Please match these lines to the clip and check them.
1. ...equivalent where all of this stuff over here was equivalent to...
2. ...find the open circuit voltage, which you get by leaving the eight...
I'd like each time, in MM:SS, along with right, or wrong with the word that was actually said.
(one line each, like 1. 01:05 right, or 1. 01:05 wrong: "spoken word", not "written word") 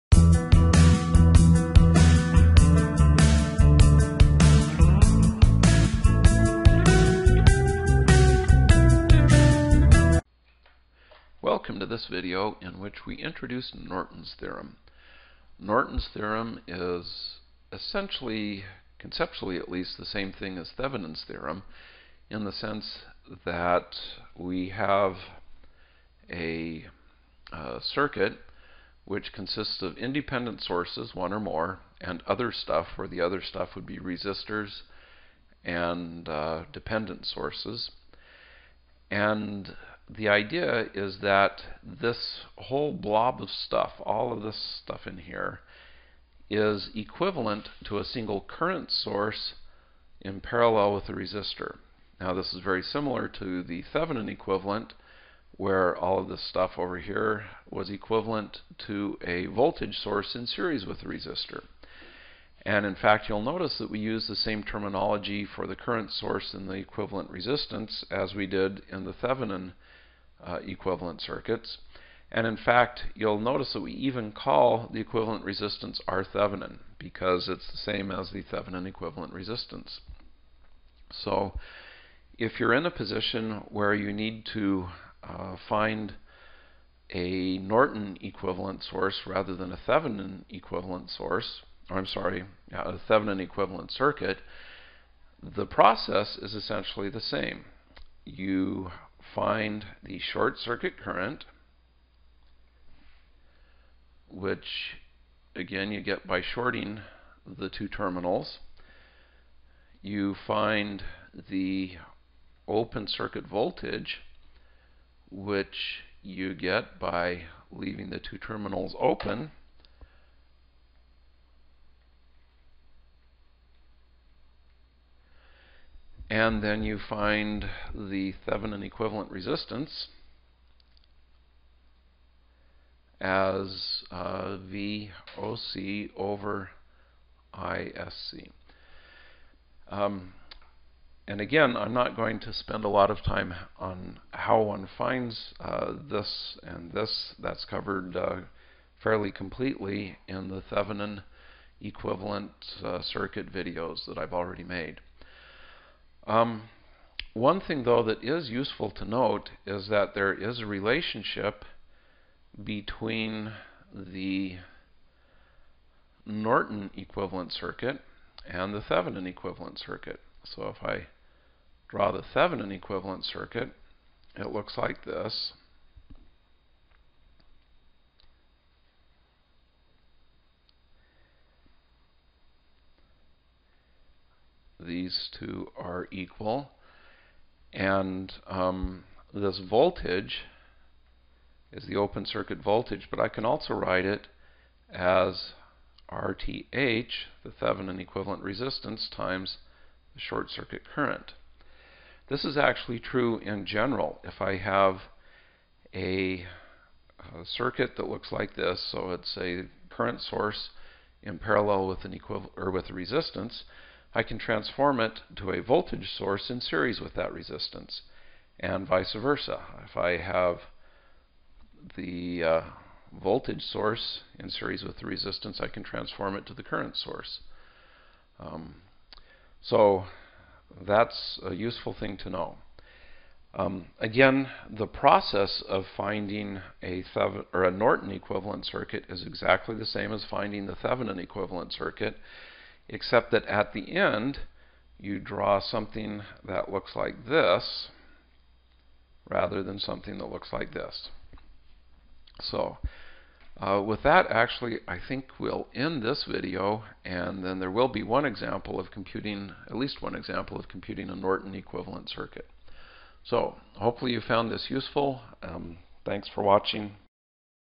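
1. 00:54 right
2. 01:50 wrong: "two", not "eight".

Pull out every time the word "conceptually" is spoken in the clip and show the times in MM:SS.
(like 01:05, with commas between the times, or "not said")
00:18.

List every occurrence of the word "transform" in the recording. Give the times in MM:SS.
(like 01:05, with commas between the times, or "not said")
03:34, 03:45.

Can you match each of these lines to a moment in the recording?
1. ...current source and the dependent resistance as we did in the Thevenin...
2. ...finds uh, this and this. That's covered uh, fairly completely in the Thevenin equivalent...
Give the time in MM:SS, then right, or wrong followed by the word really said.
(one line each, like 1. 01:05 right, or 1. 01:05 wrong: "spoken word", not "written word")
1. 01:05 wrong: "equivalent", not "dependent"
2. 02:24 right.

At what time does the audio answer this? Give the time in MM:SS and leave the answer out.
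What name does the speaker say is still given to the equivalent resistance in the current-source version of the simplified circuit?
01:16.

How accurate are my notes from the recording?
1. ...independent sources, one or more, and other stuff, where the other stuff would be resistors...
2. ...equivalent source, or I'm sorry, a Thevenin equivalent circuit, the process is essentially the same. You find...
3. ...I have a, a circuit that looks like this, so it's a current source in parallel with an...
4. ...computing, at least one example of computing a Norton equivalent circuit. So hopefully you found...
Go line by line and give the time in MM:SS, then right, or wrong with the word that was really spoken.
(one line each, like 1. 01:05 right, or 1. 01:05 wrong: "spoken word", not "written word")
1. 00:29 right
2. 01:30 right
3. 03:24 right
4. 04:18 right.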